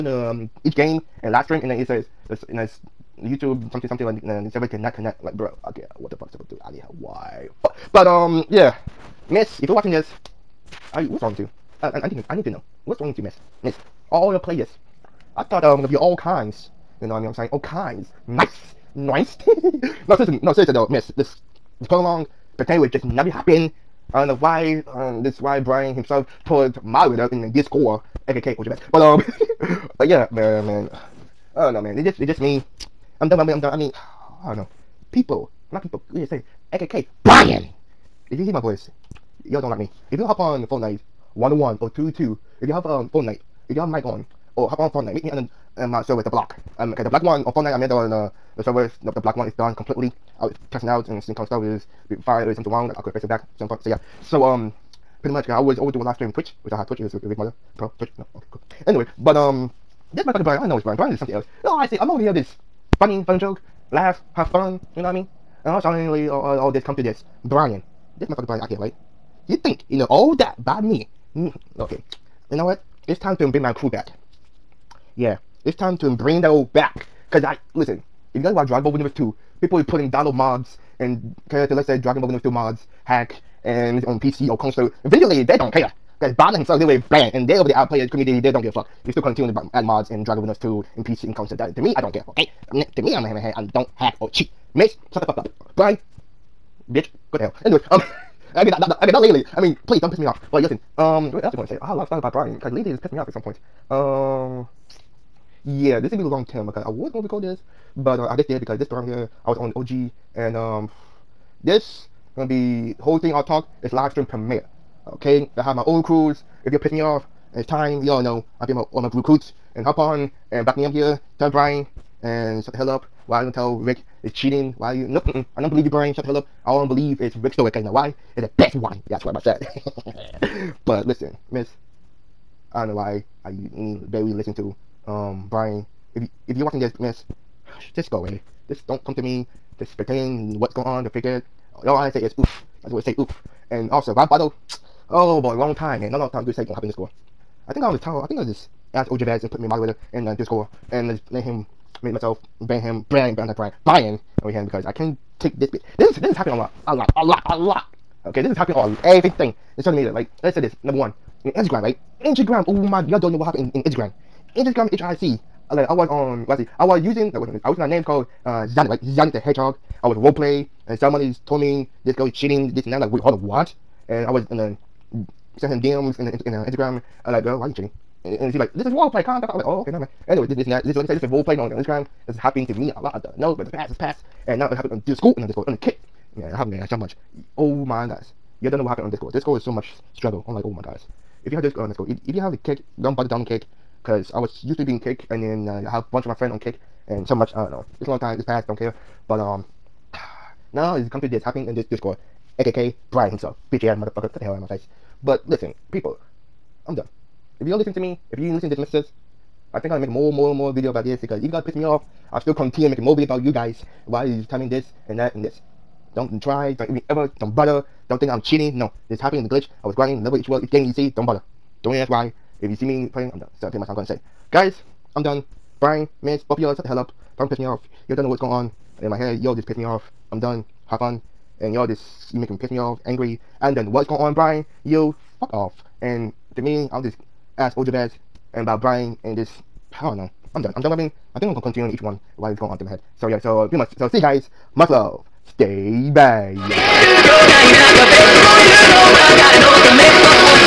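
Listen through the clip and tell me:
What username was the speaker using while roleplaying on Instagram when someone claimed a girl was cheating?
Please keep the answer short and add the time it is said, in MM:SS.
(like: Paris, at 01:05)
Zanuck the Hedgehog, at 02:49.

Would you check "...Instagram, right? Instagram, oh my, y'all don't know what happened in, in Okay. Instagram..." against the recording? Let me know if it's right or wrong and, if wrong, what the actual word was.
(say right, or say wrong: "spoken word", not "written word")
wrong: "Instagram", not "Okay".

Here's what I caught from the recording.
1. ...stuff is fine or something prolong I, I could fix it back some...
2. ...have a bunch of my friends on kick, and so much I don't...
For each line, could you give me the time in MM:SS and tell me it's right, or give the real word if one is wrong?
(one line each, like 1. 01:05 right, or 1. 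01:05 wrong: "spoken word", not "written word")
1. 00:51 wrong: "wrong", not "prolong"
2. 03:15 right.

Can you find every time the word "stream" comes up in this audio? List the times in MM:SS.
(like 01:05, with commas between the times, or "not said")
00:01, 00:56, 01:54.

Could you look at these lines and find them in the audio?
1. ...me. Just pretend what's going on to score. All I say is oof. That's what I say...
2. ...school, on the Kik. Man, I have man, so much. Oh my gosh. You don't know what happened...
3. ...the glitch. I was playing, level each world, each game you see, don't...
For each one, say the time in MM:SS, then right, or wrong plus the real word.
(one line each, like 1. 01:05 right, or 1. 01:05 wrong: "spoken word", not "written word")
1. 02:19 wrong: "figure", not "score"
2. 03:05 right
3. 03:39 wrong: "grinding", not "playing".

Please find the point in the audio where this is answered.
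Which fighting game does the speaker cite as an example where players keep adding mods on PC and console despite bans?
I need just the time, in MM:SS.
01:18.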